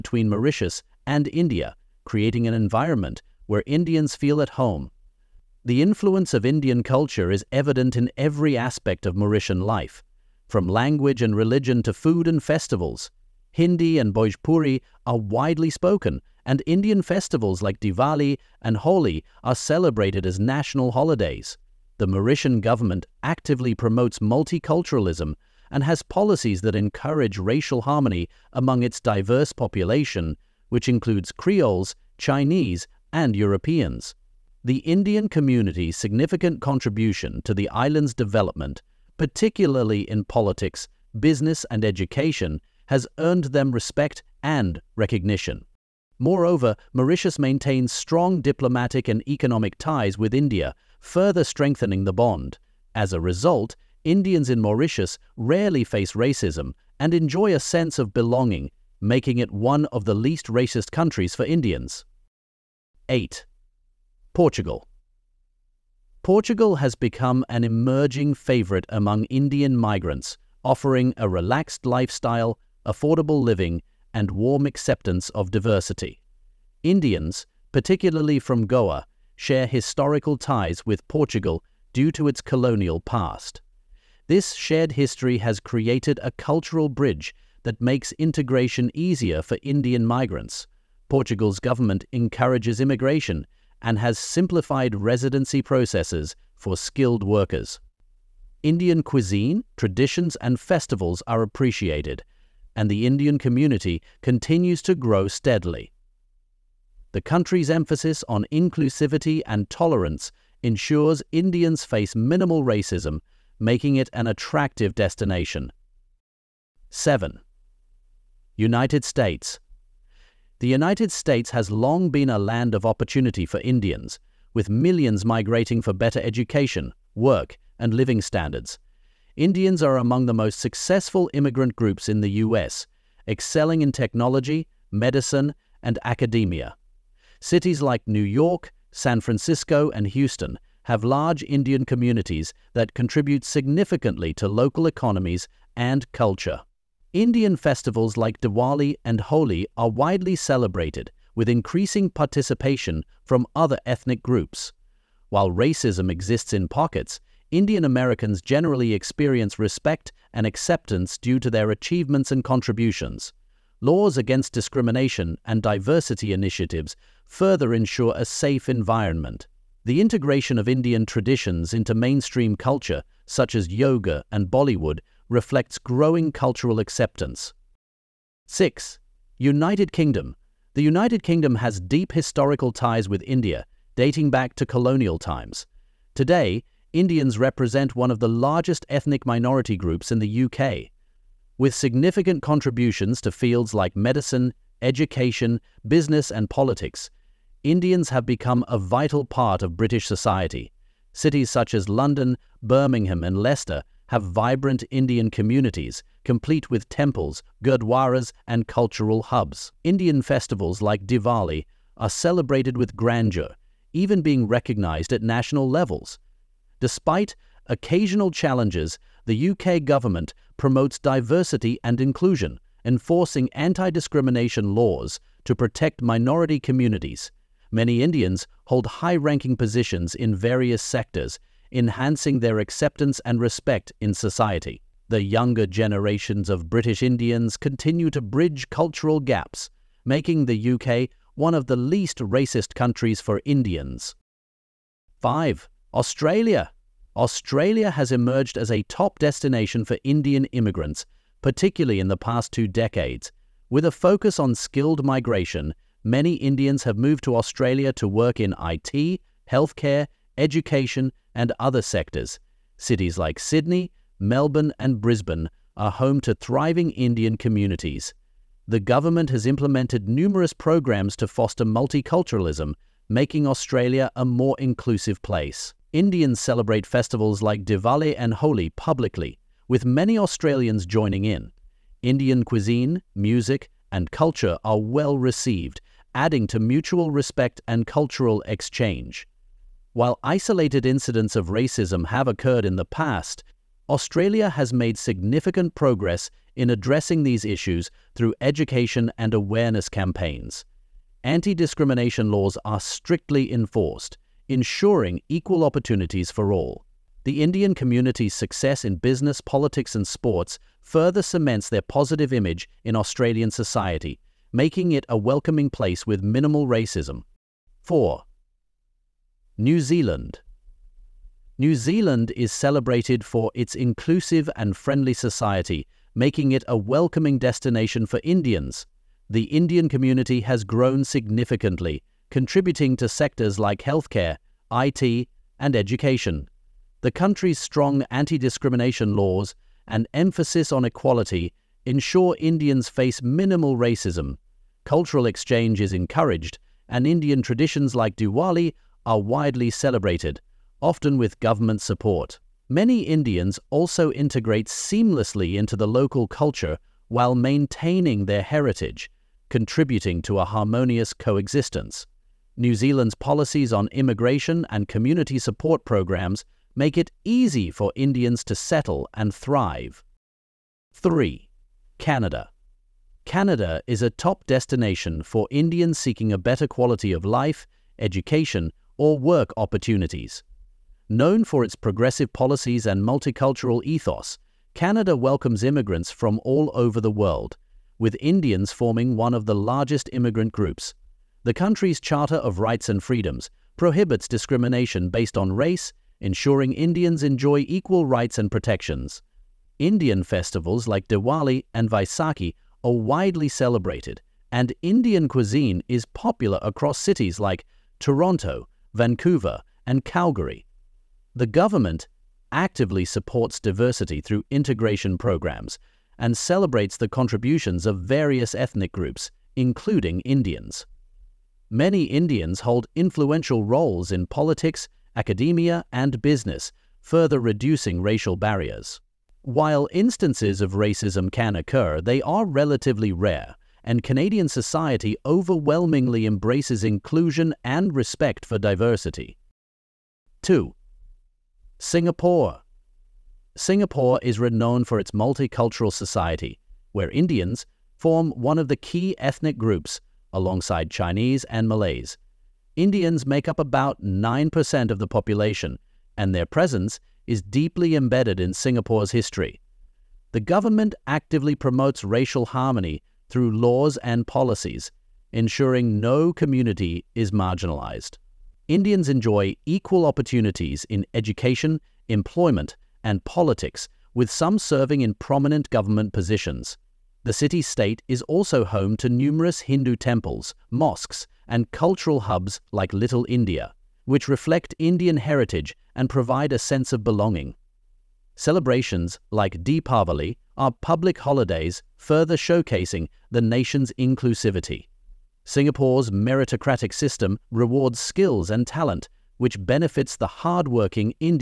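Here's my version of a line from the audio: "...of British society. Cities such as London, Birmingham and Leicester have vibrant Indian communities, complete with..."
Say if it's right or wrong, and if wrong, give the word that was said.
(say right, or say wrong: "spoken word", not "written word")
right.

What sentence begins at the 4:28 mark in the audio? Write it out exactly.
The government has implemented numerous programs to foster multiculturalism, making Australia a more inclusive place.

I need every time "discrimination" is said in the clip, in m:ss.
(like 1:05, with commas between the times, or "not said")
2:44, 3:43, 5:01, 5:38, 6:34.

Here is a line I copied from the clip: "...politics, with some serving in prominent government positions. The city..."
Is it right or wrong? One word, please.
right.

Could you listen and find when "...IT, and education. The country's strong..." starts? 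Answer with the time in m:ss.
5:34.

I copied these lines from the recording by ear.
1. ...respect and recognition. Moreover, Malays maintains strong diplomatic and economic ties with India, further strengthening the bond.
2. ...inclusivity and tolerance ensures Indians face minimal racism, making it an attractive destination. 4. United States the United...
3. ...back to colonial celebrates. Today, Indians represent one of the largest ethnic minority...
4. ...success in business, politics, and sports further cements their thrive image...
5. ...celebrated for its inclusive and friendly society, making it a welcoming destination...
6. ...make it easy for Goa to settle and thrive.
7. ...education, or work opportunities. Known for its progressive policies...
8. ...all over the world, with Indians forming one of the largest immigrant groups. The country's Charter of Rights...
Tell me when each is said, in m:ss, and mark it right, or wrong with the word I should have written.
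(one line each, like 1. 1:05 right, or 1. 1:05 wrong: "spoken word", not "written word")
1. 0:43 wrong: "Mauritius", not "Malays"
2. 1:48 wrong: "7", not "4"
3. 3:04 wrong: "times", not "celebrates"
4. 5:08 wrong: "positive", not "thrive"
5. 5:22 right
6. 6:06 wrong: "Indians", not "Goa"
7. 6:17 right
8. 6:26 right.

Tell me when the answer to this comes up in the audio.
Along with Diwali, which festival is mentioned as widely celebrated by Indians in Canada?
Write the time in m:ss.
6:41.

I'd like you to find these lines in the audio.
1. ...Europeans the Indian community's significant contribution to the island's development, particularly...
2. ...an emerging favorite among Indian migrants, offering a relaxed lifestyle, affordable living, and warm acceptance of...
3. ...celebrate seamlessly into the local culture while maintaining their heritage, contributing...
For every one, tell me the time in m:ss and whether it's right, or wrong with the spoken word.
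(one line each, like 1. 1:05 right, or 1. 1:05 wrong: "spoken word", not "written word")
1. 0:33 right
2. 1:07 right
3. 5:54 wrong: "integrate", not "celebrate".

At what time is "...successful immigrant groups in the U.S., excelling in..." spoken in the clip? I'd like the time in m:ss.
2:10.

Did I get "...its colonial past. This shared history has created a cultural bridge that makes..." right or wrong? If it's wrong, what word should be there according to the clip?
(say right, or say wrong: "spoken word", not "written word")
right.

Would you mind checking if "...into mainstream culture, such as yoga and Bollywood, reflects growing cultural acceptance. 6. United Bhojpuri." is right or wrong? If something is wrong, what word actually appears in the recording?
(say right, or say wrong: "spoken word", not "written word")
wrong: "Kingdom", not "Bhojpuri".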